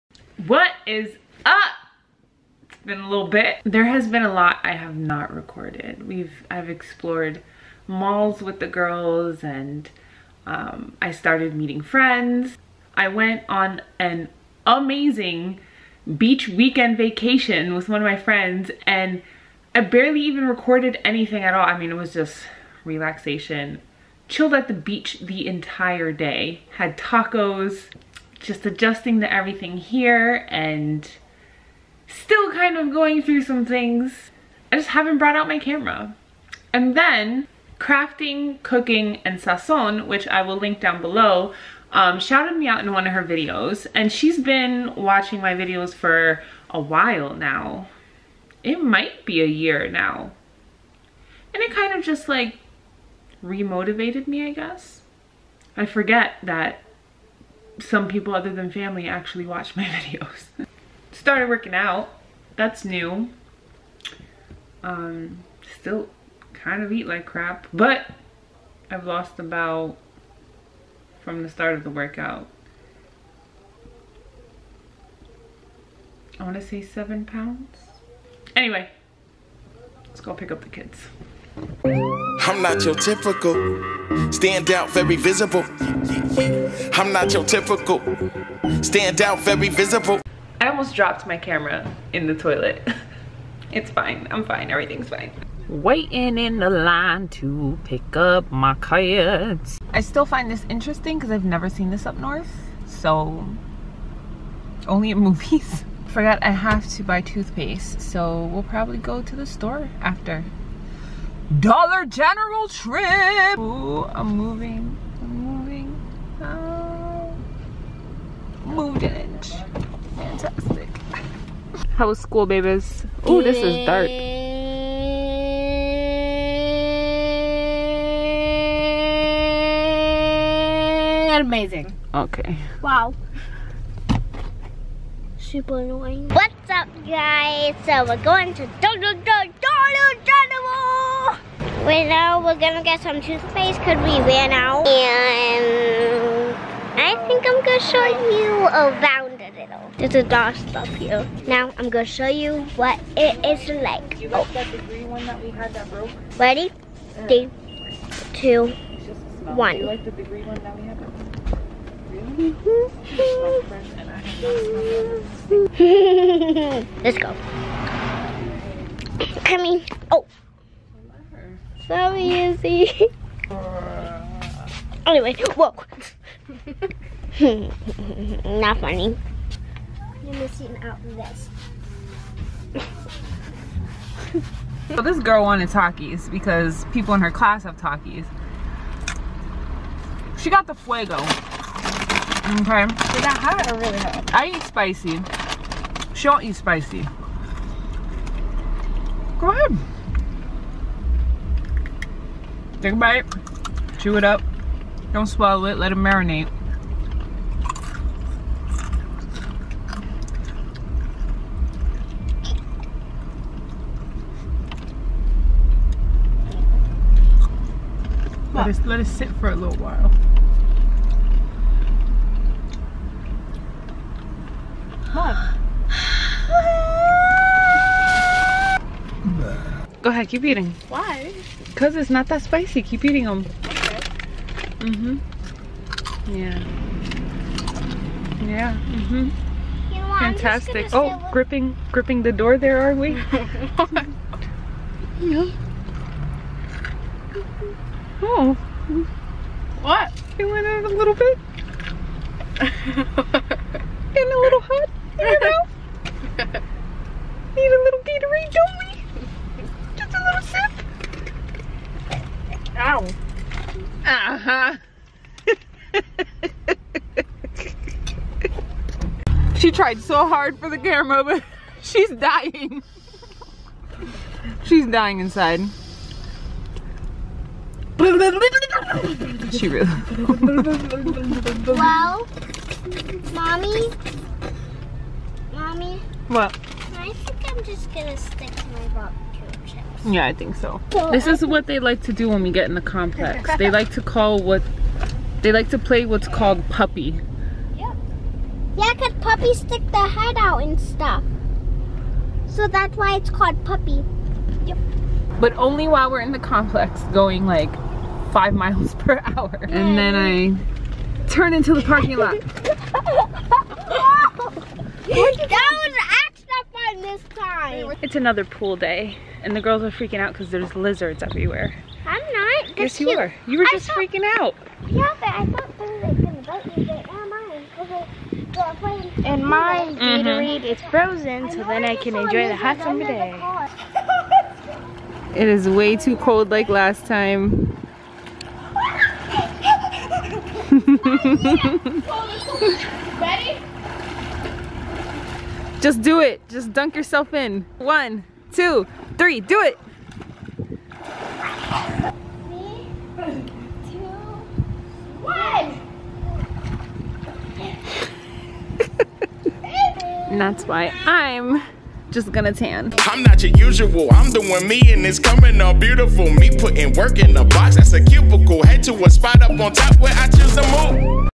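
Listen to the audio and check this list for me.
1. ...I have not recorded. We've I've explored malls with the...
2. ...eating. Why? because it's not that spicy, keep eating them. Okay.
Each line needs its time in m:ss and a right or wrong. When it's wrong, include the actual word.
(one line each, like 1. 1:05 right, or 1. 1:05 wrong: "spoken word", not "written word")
1. 0:04 right
2. 3:50 right.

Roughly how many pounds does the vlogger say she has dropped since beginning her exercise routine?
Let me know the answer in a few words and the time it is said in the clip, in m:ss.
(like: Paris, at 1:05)
7, at 1:16.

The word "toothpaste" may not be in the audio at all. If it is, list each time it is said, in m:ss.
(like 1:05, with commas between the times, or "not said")
1:47, 2:23.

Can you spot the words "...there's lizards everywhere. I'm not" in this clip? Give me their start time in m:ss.
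5:20.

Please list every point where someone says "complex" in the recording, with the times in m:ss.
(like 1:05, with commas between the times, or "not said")
4:52, 5:06.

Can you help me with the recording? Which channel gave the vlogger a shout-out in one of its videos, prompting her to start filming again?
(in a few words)
Crafting, Cooking, and Sazon.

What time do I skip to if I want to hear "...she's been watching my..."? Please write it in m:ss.
0:44.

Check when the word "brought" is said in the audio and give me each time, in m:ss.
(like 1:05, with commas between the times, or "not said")
0:35.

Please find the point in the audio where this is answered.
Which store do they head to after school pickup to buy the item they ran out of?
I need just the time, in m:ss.
1:51.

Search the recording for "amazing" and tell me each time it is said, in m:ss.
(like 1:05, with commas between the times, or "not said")
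0:14, 2:11.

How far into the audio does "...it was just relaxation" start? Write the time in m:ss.
0:21.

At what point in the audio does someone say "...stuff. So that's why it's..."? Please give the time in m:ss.
5:00.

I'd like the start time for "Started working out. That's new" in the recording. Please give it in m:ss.
1:01.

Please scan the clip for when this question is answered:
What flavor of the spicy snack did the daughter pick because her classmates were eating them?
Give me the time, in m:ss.
3:10.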